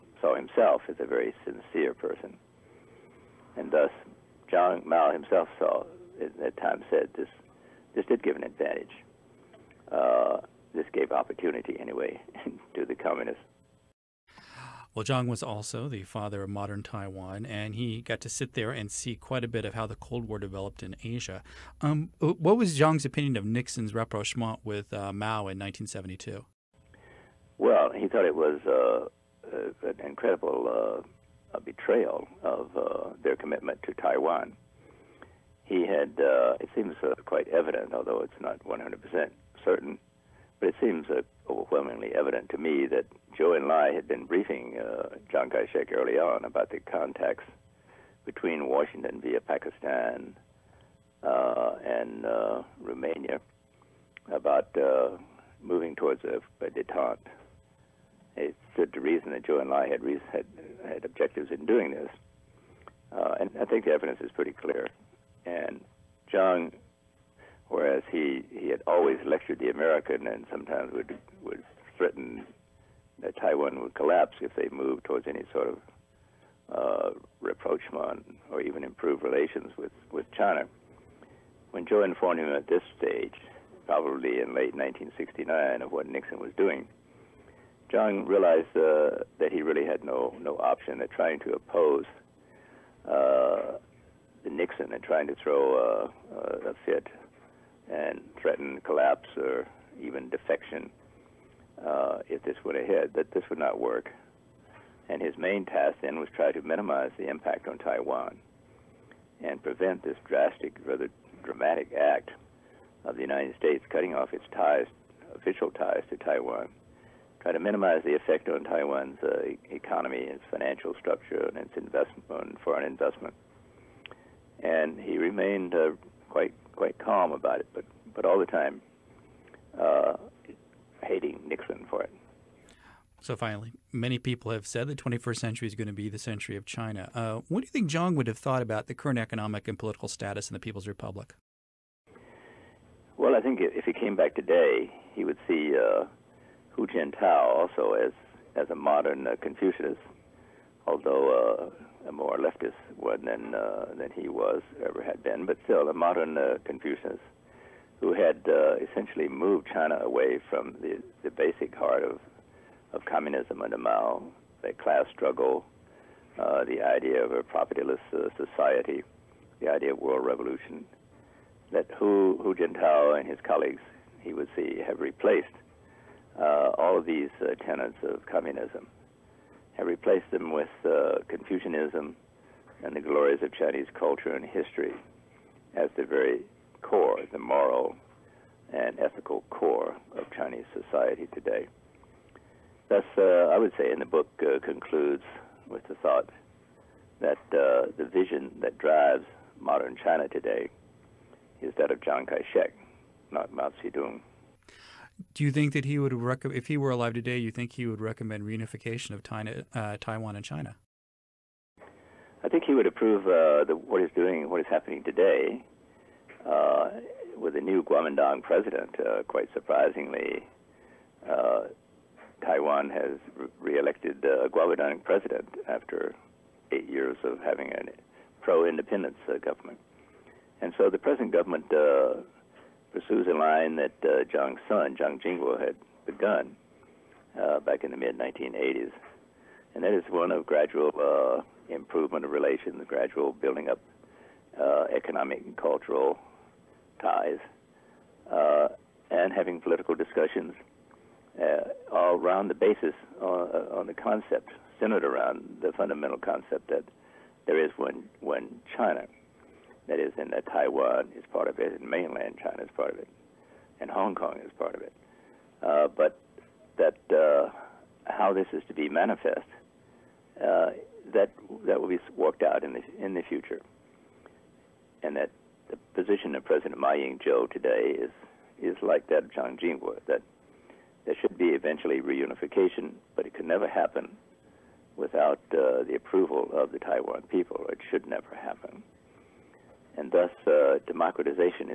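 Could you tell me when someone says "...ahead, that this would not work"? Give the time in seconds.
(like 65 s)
102 s.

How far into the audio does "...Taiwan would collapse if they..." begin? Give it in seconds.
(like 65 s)
73 s.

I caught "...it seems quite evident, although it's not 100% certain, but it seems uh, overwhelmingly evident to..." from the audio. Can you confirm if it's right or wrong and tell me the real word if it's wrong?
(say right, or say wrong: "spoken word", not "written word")
right.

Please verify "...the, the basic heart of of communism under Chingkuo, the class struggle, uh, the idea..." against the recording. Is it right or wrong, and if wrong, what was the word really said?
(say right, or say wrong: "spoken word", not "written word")
wrong: "Mao", not "Chingkuo".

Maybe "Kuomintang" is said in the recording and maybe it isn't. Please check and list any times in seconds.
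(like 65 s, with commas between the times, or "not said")
217 s, 224 s.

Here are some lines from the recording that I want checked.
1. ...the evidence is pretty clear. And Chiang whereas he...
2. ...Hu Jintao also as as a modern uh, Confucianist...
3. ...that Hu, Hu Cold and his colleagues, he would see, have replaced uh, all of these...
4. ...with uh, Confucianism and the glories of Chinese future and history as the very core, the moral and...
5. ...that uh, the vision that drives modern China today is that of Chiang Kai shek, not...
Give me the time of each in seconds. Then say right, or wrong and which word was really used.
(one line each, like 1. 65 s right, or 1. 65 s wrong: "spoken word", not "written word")
1. 63 s right
2. 146 s right
3. 171 s wrong: "Jintao", not "Cold"
4. 180 s wrong: "culture", not "future"
5. 197 s right.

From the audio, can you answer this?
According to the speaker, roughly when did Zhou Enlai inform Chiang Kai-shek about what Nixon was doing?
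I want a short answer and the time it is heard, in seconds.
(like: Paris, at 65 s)
late 1969, at 84 s.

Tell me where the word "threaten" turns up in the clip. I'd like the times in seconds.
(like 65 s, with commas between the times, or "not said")
71 s, 98 s.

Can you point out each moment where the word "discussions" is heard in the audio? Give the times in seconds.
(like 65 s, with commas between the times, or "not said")
249 s.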